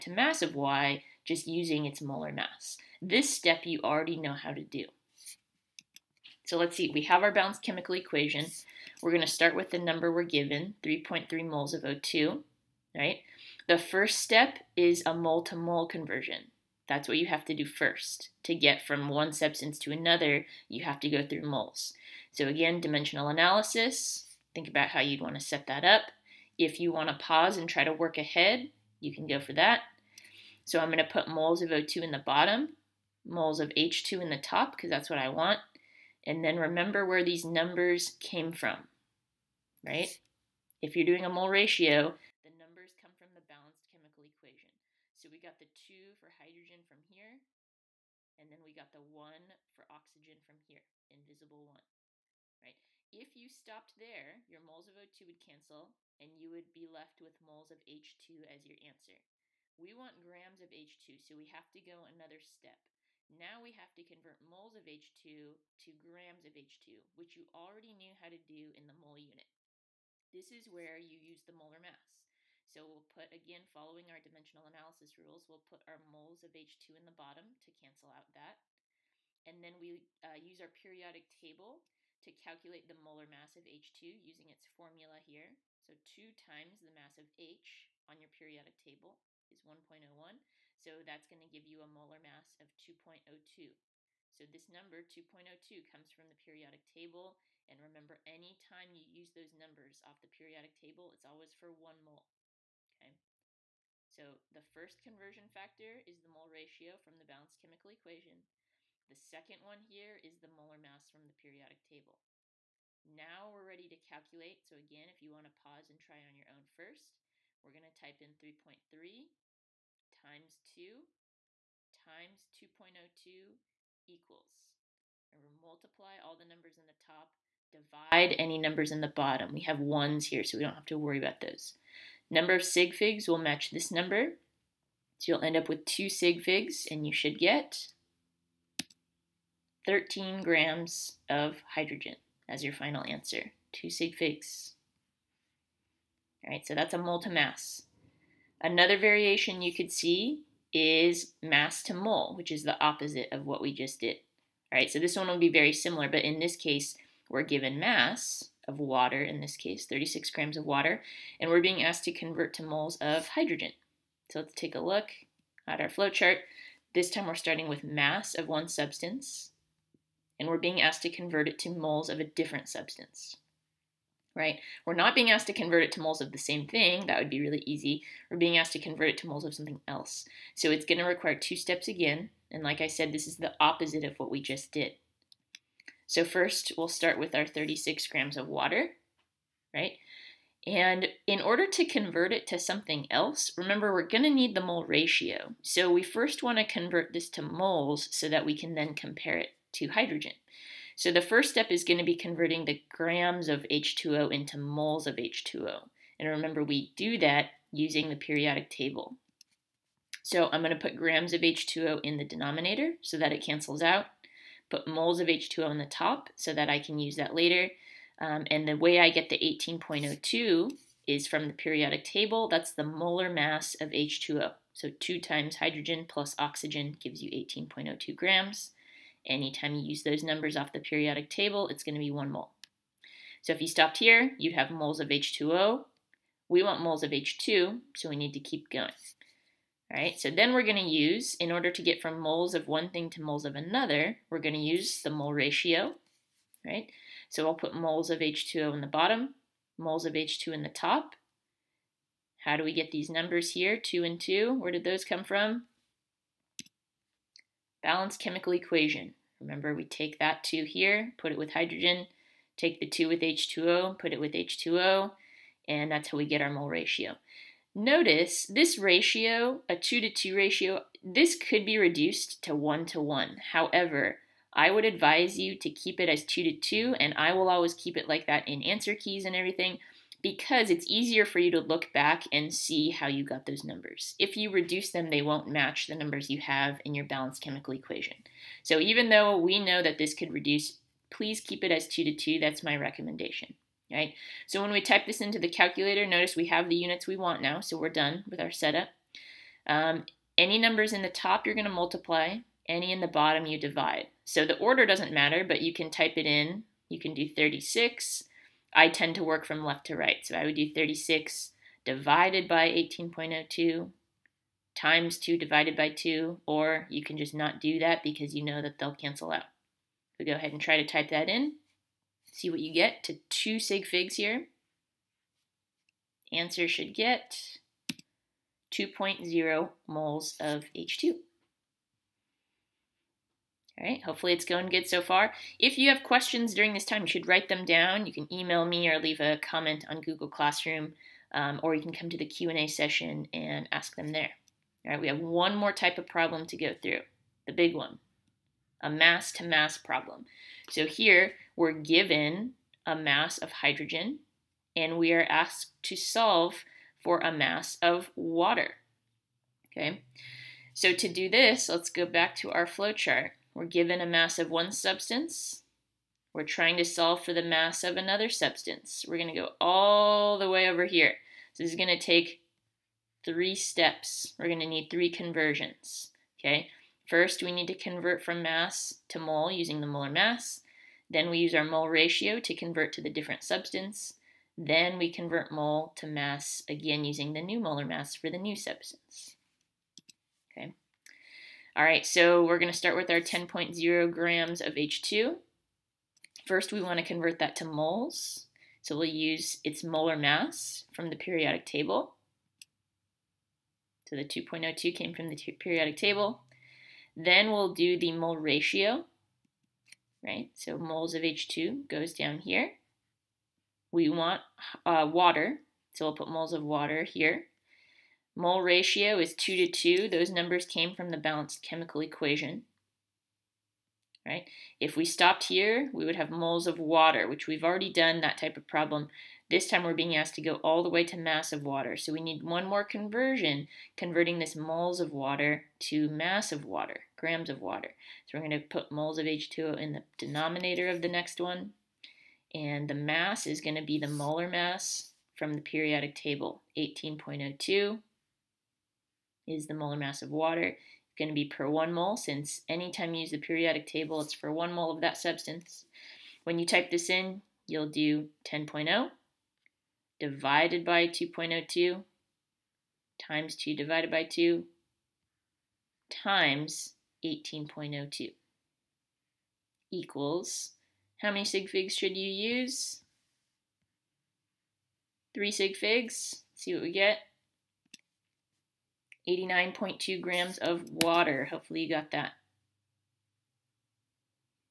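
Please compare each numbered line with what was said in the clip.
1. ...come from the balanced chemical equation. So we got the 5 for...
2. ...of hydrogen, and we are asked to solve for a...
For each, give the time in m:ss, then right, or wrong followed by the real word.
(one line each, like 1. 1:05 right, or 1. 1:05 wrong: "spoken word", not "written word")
1. 0:42 wrong: "2", not "5"
2. 5:53 right.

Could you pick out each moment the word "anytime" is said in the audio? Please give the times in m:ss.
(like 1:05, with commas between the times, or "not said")
1:38, 3:49, 7:32.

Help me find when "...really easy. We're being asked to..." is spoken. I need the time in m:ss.
2:57.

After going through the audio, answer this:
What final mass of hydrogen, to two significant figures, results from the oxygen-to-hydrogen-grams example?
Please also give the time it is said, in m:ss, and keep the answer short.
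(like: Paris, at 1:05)
13 grams, at 2:19.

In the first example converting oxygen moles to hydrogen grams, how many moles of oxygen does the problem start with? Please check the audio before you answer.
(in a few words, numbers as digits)
3.3 moles.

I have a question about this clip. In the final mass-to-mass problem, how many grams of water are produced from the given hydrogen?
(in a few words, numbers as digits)
89.2 grams.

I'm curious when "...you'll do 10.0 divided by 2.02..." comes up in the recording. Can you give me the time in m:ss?
7:37.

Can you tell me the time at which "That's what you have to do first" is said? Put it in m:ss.
0:16.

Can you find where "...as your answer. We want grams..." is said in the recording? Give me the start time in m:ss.
0:58.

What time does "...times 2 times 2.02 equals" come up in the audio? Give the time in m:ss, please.
2:00.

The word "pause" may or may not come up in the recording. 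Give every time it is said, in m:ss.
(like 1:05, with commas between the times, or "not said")
0:27, 1:55.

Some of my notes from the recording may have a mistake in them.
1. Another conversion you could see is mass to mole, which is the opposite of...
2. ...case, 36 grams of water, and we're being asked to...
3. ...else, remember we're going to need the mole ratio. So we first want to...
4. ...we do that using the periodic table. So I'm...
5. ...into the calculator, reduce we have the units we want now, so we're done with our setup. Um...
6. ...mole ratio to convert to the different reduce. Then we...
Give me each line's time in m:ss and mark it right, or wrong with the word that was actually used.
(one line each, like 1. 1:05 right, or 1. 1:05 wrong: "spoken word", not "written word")
1. 2:28 wrong: "variation", not "conversion"
2. 2:39 right
3. 3:13 right
4. 3:26 right
5. 4:55 wrong: "notice", not "reduce"
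6. 6:21 wrong: "substance", not "reduce".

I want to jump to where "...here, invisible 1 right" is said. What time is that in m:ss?
0:50.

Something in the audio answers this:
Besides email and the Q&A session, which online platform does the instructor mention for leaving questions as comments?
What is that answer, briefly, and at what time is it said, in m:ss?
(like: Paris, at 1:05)
Google Classroom, at 5:40.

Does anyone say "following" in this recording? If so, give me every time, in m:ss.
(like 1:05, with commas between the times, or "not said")
1:13.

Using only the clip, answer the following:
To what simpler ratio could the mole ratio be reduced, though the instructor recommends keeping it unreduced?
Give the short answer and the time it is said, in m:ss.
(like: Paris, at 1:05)
1 to 1, at 4:32.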